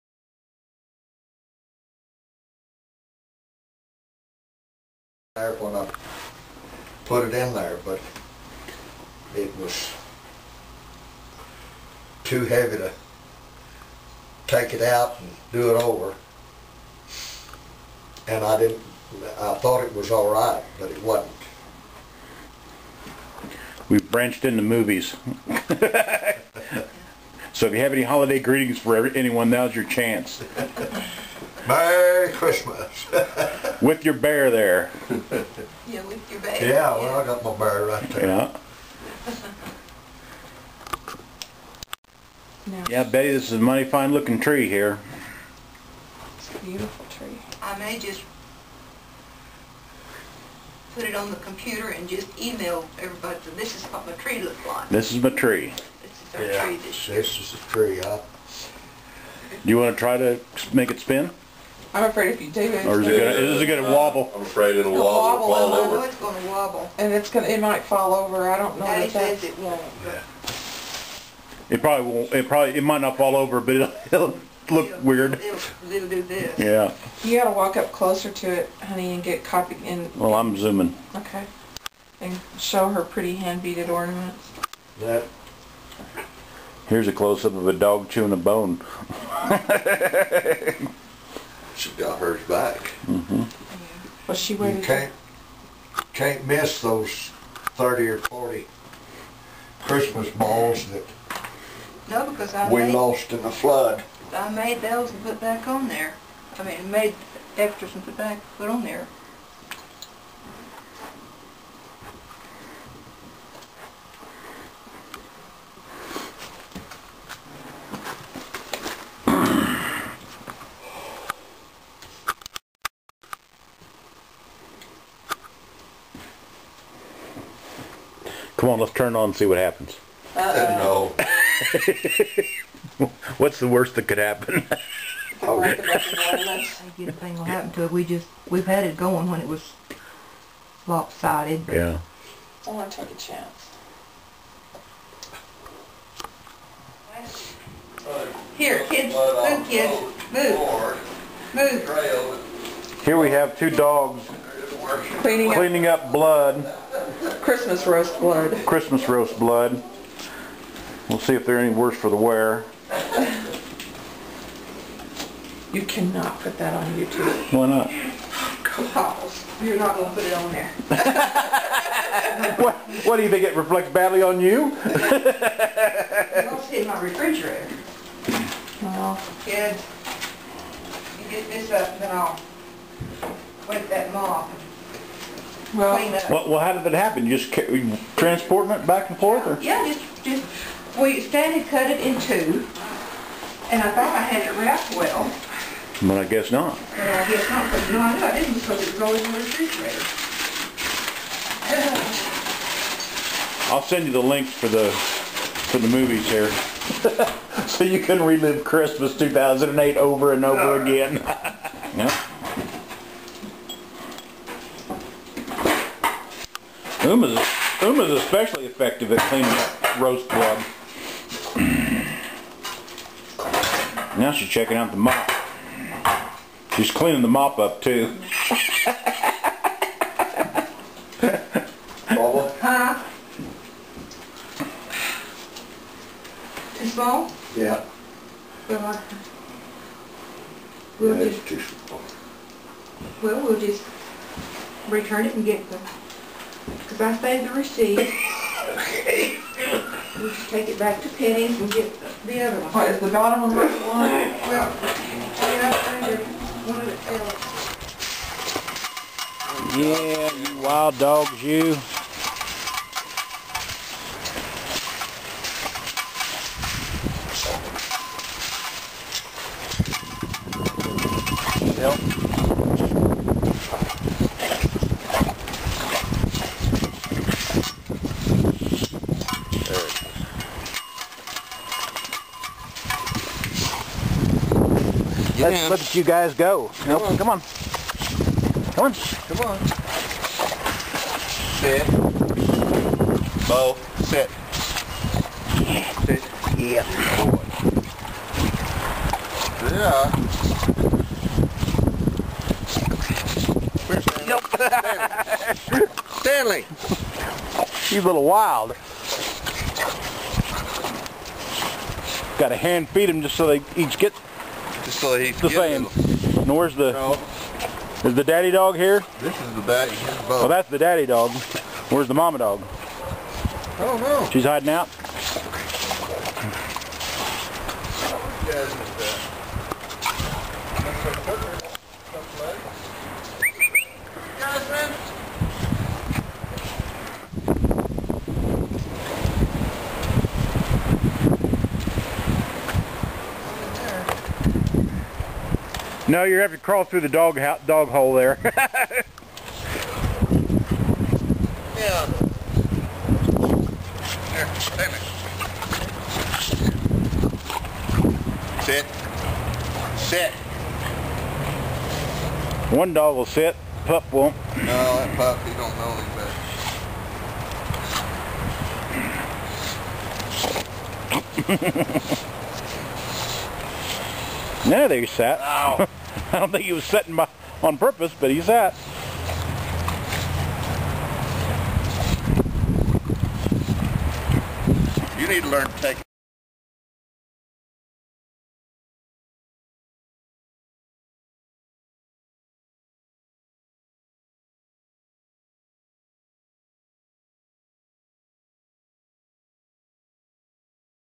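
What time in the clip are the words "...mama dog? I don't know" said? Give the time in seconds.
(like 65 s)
322 s.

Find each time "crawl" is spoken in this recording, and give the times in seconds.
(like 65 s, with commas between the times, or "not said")
346 s.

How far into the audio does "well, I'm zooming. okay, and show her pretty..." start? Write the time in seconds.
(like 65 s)
80 s.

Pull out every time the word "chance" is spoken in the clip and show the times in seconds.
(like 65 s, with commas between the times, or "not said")
29 s, 143 s.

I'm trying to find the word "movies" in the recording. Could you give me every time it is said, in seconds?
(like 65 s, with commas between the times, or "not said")
24 s, 205 s.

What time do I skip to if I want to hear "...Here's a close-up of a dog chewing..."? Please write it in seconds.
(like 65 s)
86 s.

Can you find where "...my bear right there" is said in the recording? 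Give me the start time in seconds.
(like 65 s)
37 s.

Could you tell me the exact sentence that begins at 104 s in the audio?
I made those and put back on there.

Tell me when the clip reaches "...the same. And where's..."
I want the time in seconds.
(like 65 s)
315 s.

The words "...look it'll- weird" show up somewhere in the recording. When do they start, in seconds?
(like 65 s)
74 s.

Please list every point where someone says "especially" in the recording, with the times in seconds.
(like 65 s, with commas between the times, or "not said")
218 s.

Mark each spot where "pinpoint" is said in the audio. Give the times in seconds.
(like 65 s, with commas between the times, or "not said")
not said.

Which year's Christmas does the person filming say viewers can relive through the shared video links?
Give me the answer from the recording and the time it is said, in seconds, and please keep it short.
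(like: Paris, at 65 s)
2008, at 209 s.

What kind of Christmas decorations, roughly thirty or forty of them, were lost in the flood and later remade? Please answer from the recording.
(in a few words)
Christmas balls.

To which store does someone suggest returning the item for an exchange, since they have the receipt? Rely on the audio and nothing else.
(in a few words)
Penney's.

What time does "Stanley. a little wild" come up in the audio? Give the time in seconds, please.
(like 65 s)
306 s.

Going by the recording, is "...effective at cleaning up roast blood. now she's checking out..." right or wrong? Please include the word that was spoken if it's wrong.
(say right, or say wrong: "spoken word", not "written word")
right.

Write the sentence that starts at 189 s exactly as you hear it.
Yeah, just, just, we and cut it in two, and I thought I had it wrapped well.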